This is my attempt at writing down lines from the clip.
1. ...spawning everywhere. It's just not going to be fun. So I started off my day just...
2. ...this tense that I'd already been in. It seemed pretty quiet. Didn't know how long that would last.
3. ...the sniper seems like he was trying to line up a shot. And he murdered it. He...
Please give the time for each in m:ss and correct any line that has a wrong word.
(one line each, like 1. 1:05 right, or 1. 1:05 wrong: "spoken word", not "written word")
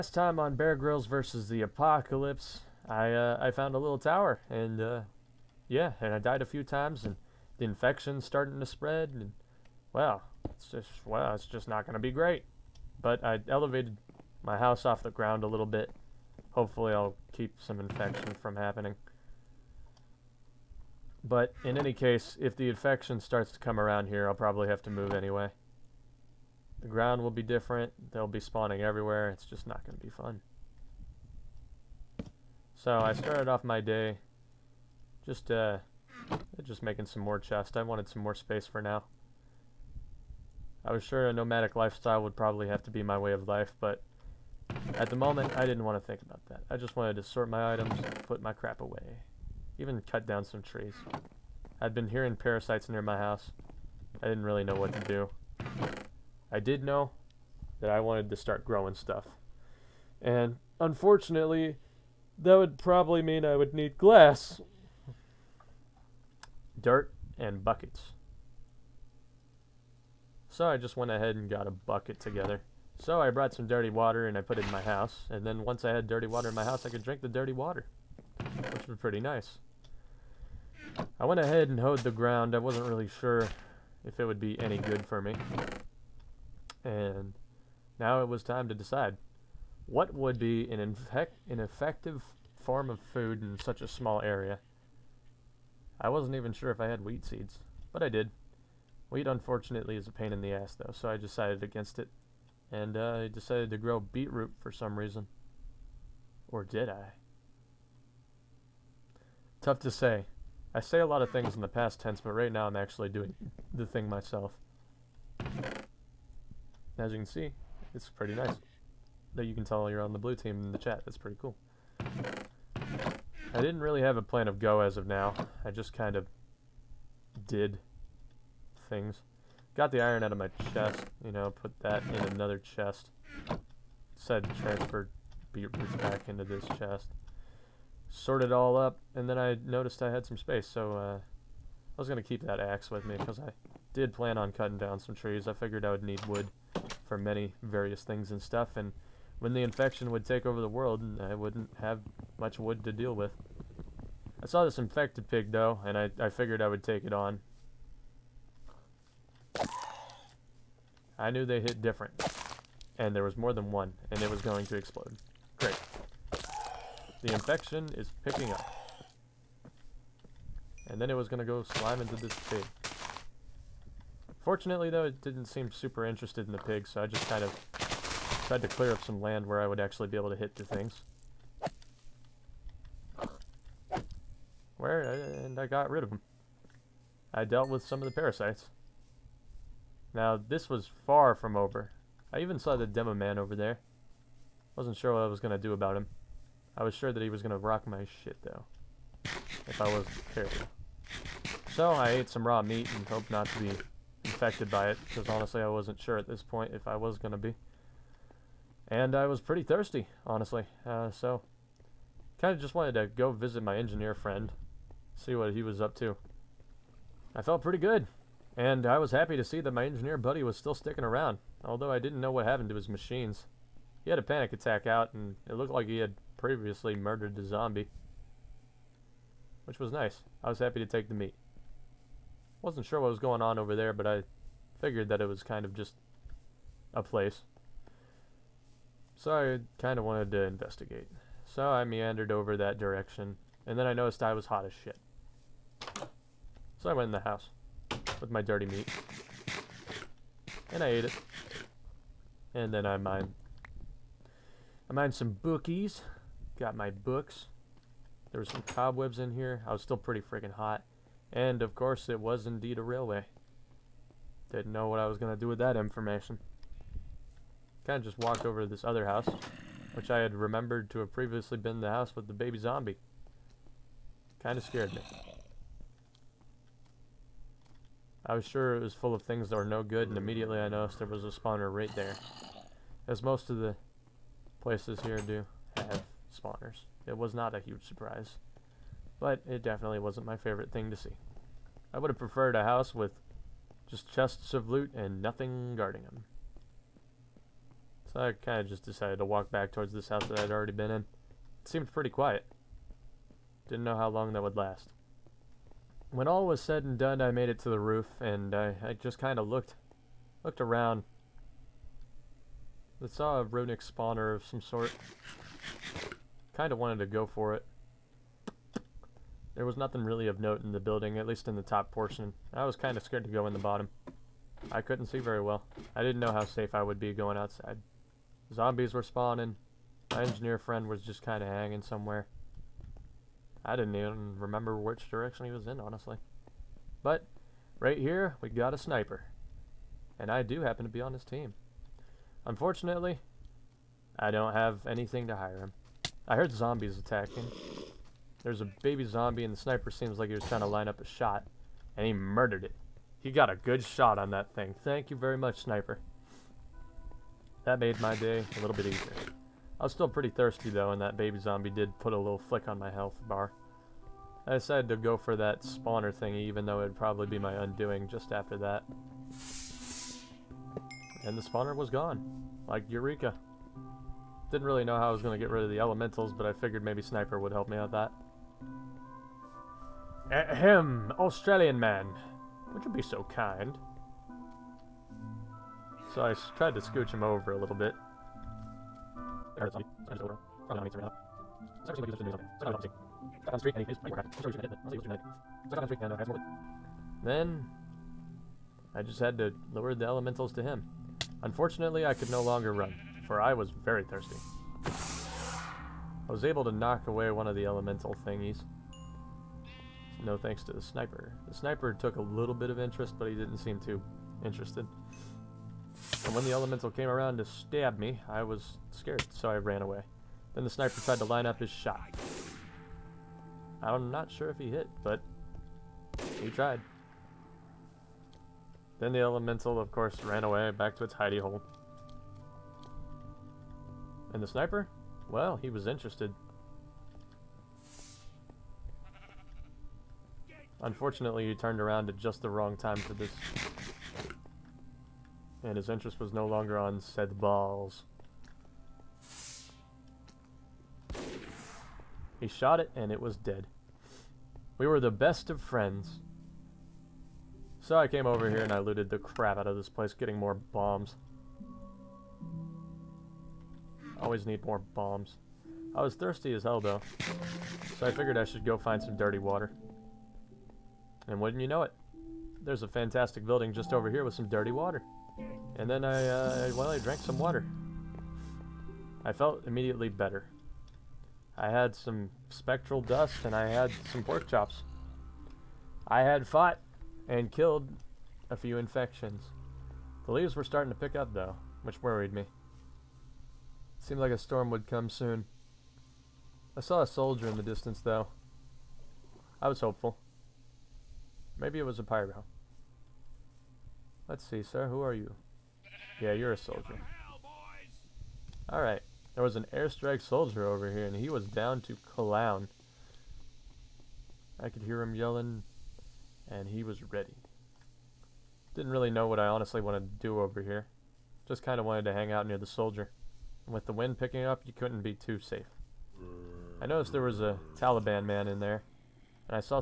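1. 0:28 right
2. 4:59 wrong: "house", not "tense"
3. 5:49 right.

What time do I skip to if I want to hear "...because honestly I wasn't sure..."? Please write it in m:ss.
3:25.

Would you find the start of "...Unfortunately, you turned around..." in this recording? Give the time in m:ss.
7:20.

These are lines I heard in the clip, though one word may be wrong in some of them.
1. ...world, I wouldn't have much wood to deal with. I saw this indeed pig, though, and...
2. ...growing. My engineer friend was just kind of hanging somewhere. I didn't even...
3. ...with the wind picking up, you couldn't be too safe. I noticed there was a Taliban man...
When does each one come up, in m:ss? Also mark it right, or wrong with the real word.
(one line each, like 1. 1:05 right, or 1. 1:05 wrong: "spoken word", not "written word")
1. 2:30 wrong: "infected", not "indeed"
2. 5:29 wrong: "spawning", not "growing"
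3. 8:43 right.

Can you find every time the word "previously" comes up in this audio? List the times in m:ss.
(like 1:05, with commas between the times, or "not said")
3:46, 4:31.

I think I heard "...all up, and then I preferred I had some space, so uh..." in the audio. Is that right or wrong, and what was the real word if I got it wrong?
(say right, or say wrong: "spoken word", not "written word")
wrong: "noticed", not "preferred".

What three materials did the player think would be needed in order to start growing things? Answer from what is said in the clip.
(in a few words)
glass, dirt, and buckets.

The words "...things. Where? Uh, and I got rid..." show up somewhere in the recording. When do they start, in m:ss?
3:00.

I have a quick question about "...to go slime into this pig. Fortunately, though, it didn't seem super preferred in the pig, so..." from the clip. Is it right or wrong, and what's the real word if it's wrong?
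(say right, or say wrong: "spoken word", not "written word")
wrong: "interested", not "preferred".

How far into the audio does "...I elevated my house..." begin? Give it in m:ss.
0:13.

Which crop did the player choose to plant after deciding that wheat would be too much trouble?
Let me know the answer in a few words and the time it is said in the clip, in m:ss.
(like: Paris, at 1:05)
Beetroot, at 1:44.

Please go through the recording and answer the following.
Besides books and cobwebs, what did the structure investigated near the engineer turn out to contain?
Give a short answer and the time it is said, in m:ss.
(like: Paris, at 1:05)
A railway, at 4:22.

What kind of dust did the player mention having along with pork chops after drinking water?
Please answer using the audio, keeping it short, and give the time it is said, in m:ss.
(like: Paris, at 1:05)
Spectral dust, at 8:02.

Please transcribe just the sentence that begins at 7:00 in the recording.
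Then the sniper tried to line up his shot.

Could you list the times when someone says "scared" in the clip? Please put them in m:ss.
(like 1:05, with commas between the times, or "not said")
4:34, 5:23, 6:58.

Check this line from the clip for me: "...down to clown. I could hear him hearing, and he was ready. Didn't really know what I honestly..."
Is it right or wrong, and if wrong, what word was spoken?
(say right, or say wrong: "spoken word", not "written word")
wrong: "yelling", not "hearing".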